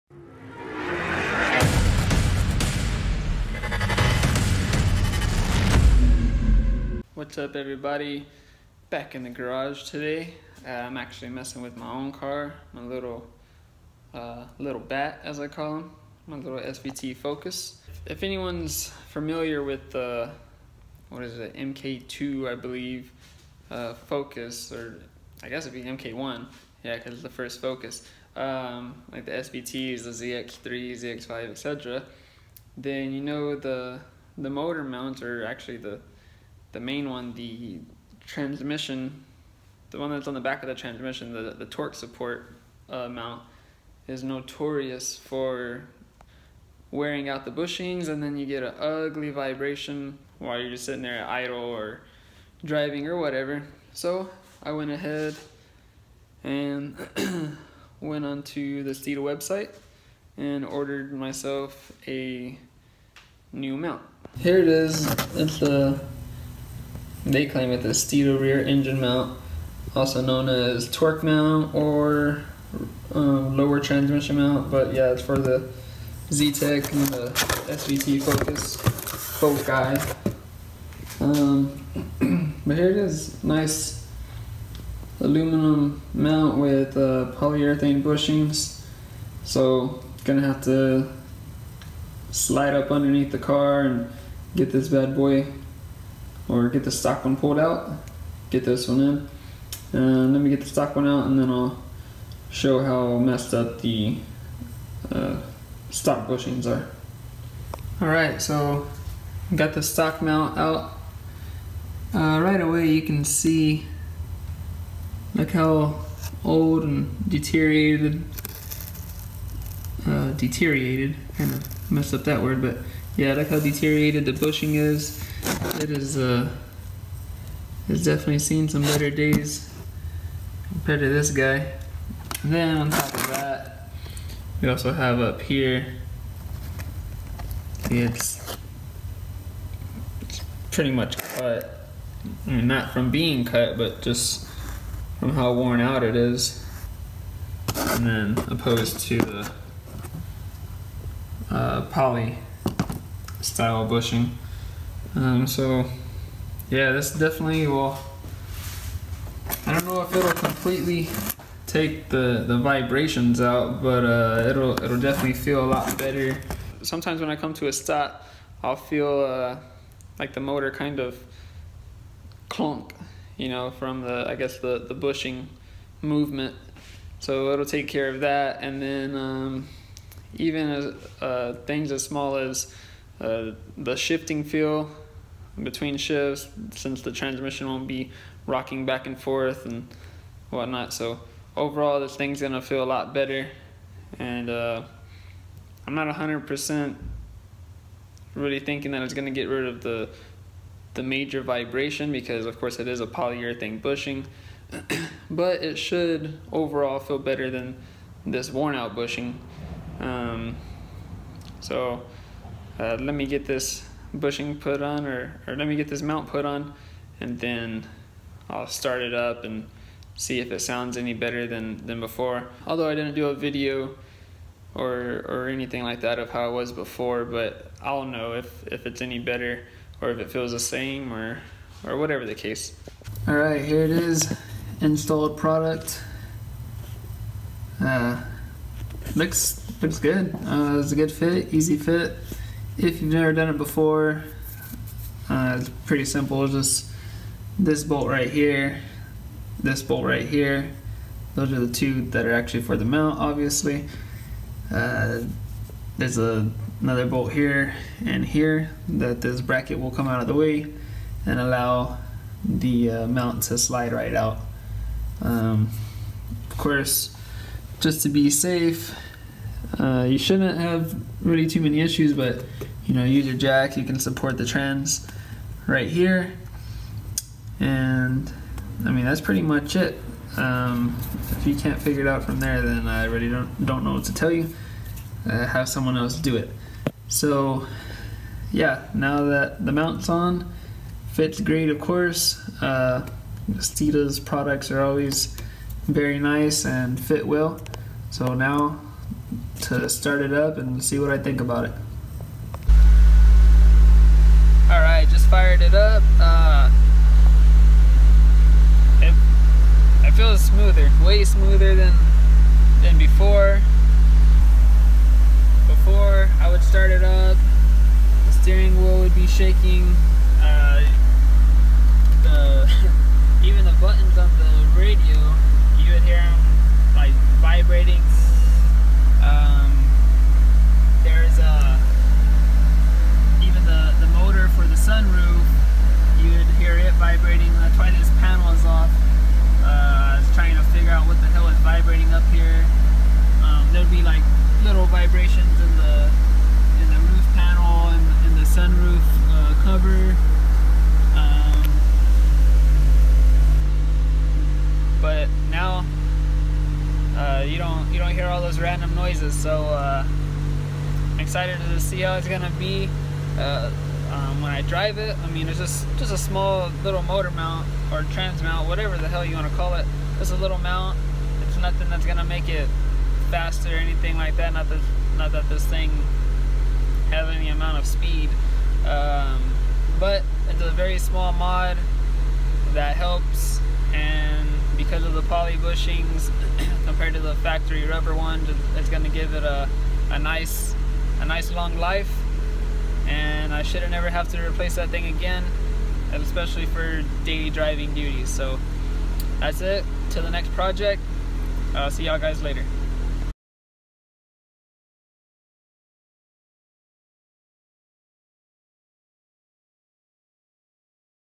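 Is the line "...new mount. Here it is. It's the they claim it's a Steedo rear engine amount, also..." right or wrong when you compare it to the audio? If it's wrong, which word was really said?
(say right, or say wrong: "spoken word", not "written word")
wrong: "mount", not "amount".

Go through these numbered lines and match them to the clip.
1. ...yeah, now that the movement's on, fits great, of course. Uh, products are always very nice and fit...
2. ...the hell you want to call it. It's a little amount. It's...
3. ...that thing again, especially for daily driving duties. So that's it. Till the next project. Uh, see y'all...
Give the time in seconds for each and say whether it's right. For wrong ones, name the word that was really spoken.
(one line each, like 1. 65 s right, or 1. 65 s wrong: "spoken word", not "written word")
1. 288 s wrong: "mount", not "movement"
2. 368 s wrong: "mount", not "amount"
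3. 394 s right.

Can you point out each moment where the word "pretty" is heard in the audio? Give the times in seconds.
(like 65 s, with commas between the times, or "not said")
140 s, 245 s, 279 s.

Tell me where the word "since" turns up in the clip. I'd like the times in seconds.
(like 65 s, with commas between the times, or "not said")
186 s.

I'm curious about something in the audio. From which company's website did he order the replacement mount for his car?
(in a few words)
Steeda.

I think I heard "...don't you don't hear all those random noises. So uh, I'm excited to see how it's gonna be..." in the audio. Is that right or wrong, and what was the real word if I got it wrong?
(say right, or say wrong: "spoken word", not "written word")
right.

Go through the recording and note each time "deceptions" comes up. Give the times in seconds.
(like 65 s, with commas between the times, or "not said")
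not said.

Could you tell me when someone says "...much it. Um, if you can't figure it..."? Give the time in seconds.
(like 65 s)
279 s.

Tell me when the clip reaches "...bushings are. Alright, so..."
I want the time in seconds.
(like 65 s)
106 s.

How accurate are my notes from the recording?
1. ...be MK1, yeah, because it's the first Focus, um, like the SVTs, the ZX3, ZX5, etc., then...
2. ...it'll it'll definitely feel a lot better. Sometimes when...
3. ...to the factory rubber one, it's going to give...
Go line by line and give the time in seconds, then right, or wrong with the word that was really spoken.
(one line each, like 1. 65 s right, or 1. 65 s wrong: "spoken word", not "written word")
1. 25 s right
2. 164 s right
3. 387 s right.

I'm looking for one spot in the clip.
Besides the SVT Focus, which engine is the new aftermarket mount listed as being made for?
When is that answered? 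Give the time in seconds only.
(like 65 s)
76 s.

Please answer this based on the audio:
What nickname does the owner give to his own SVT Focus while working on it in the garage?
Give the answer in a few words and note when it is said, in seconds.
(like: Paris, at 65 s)
little bat, at 14 s.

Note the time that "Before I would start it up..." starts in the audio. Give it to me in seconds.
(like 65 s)
315 s.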